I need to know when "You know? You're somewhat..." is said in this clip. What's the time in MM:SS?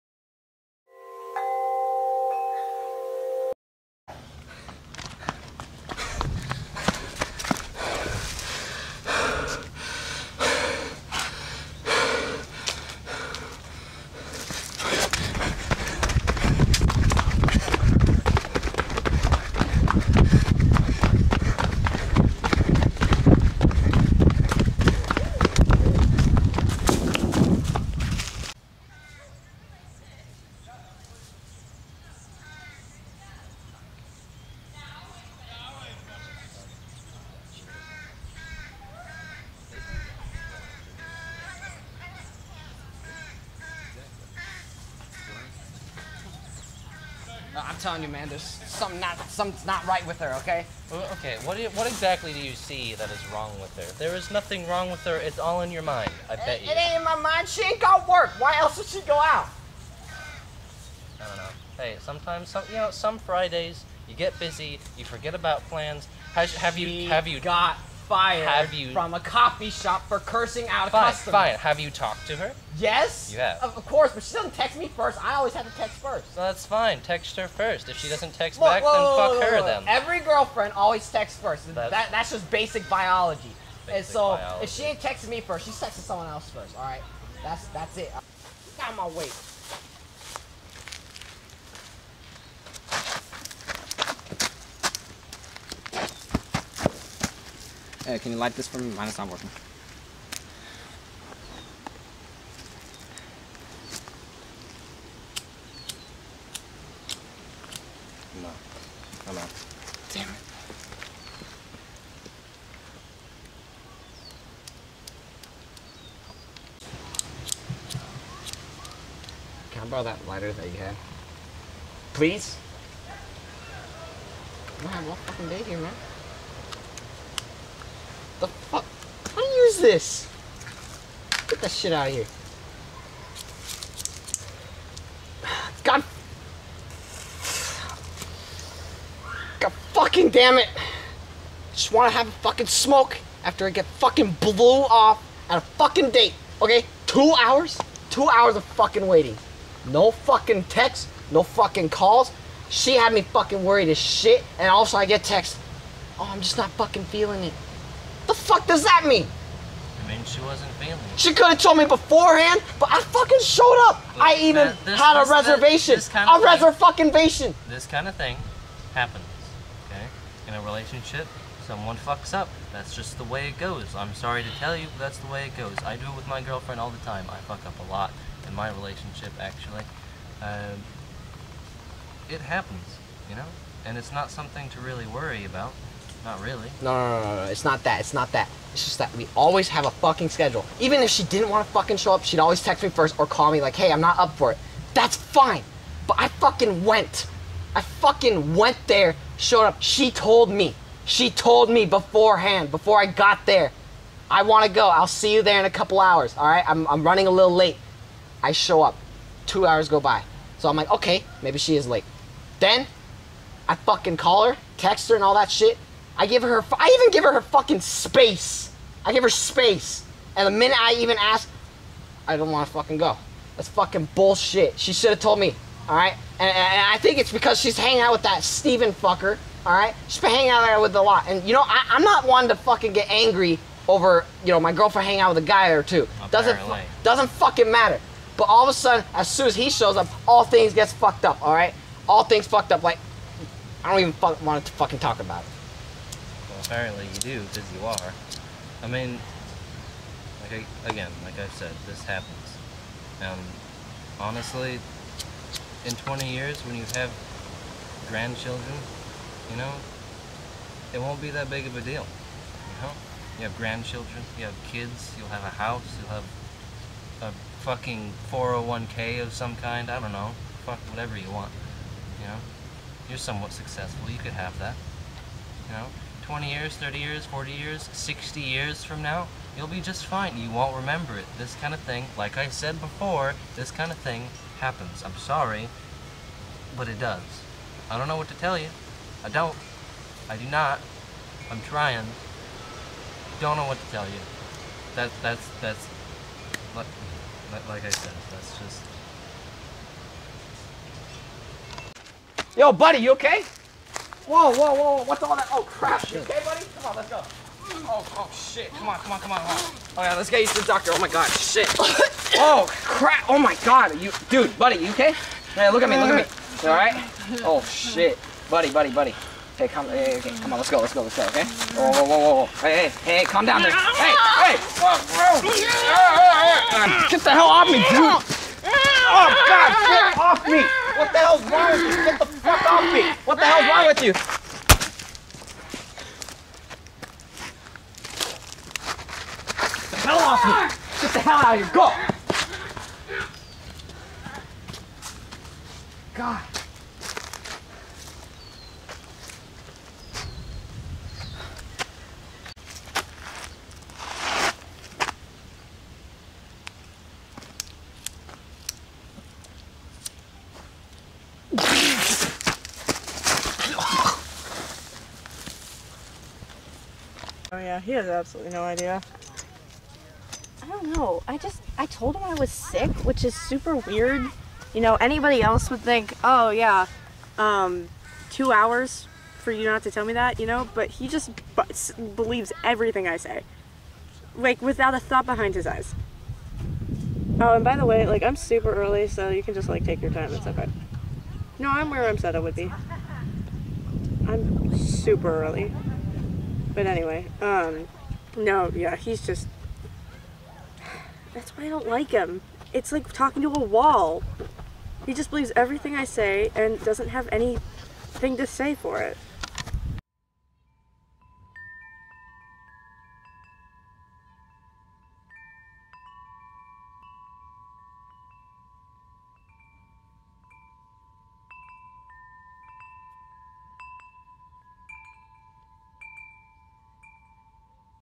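04:32.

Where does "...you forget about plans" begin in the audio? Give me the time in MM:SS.
01:04.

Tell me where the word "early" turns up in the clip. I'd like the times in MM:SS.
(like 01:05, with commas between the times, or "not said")
06:28, 06:35.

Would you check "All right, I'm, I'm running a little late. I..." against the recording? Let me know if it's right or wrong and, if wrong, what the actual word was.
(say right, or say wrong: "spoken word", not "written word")
right.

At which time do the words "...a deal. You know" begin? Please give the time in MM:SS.
04:21.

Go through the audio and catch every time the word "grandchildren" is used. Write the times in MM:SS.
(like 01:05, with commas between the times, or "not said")
04:18, 04:23.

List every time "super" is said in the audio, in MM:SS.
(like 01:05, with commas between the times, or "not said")
06:13, 06:28, 06:34.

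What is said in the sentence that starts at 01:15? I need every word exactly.
I always have to text first.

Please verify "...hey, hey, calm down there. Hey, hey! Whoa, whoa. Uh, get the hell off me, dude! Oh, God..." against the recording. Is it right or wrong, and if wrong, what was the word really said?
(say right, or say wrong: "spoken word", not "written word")
right.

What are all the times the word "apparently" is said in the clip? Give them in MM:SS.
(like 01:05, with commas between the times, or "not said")
03:56, 04:06.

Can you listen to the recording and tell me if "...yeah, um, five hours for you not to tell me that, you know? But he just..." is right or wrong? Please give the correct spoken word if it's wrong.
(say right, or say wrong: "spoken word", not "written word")
wrong: "two", not "five".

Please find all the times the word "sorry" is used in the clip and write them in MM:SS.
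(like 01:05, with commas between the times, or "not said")
02:54, 04:45.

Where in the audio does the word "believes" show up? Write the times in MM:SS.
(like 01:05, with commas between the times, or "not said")
06:22, 06:45.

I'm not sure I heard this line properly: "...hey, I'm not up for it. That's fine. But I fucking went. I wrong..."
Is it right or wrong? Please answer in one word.
wrong.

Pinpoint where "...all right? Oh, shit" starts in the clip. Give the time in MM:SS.
05:16.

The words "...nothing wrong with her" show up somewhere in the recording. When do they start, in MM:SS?
00:54.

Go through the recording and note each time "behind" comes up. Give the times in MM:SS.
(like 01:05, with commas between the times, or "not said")
06:25.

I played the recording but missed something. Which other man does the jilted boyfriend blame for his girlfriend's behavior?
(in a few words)
Steven.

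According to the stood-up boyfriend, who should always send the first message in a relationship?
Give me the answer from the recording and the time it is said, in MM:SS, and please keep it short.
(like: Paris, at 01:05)
Every girlfriend, at 01:19.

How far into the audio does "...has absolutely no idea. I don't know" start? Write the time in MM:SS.
06:07.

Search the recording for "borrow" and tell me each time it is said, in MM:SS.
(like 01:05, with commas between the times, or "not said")
01:59.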